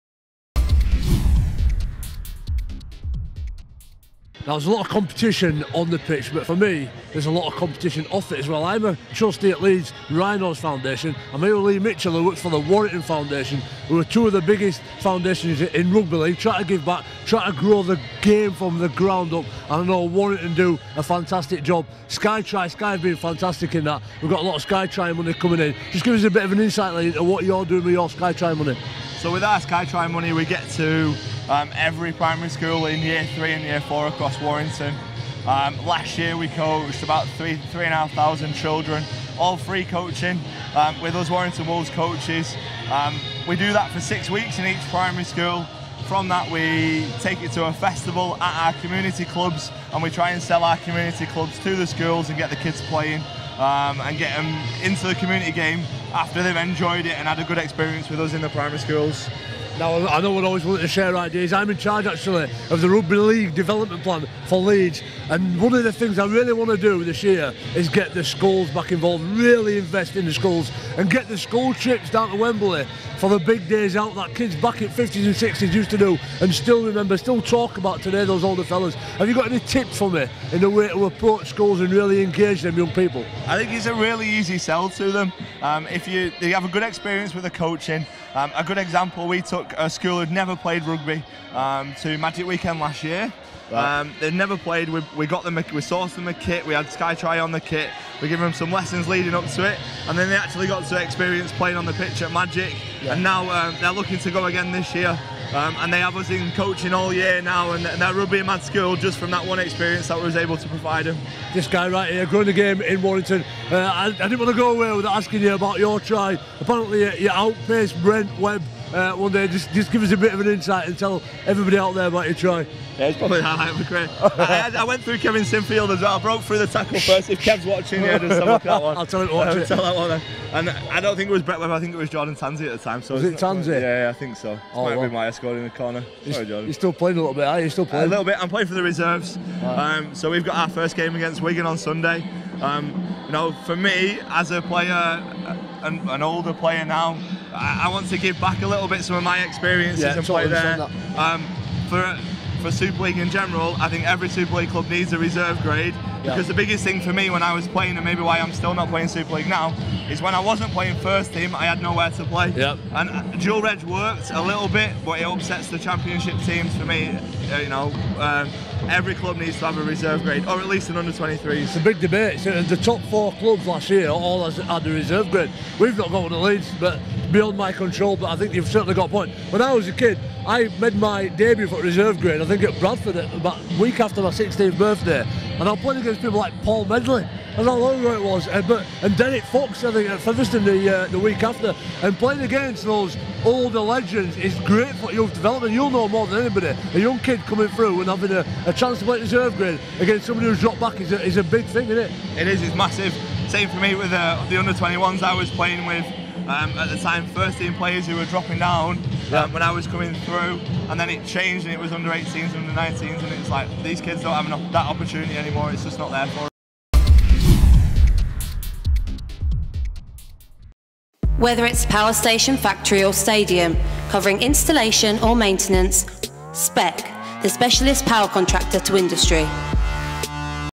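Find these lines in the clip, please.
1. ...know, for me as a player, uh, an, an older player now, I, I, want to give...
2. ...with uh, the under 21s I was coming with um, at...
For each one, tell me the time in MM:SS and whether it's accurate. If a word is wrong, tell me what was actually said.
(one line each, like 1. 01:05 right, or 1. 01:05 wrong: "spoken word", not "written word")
1. 02:23 right
2. 03:23 wrong: "playing", not "coming".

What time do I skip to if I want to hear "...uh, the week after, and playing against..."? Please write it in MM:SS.
03:11.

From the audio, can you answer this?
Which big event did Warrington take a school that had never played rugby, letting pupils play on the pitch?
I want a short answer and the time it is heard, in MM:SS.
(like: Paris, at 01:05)
Magic Weekend, at 01:32.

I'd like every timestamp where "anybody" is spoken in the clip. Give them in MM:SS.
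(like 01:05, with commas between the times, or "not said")
03:16.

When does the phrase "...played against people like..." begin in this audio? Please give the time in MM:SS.
03:05.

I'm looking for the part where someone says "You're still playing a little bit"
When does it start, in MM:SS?
02:16.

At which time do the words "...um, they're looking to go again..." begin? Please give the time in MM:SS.
01:43.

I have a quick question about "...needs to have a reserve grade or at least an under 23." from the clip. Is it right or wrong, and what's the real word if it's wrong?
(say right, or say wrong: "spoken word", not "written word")
right.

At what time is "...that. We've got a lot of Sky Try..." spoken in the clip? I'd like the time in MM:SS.
00:23.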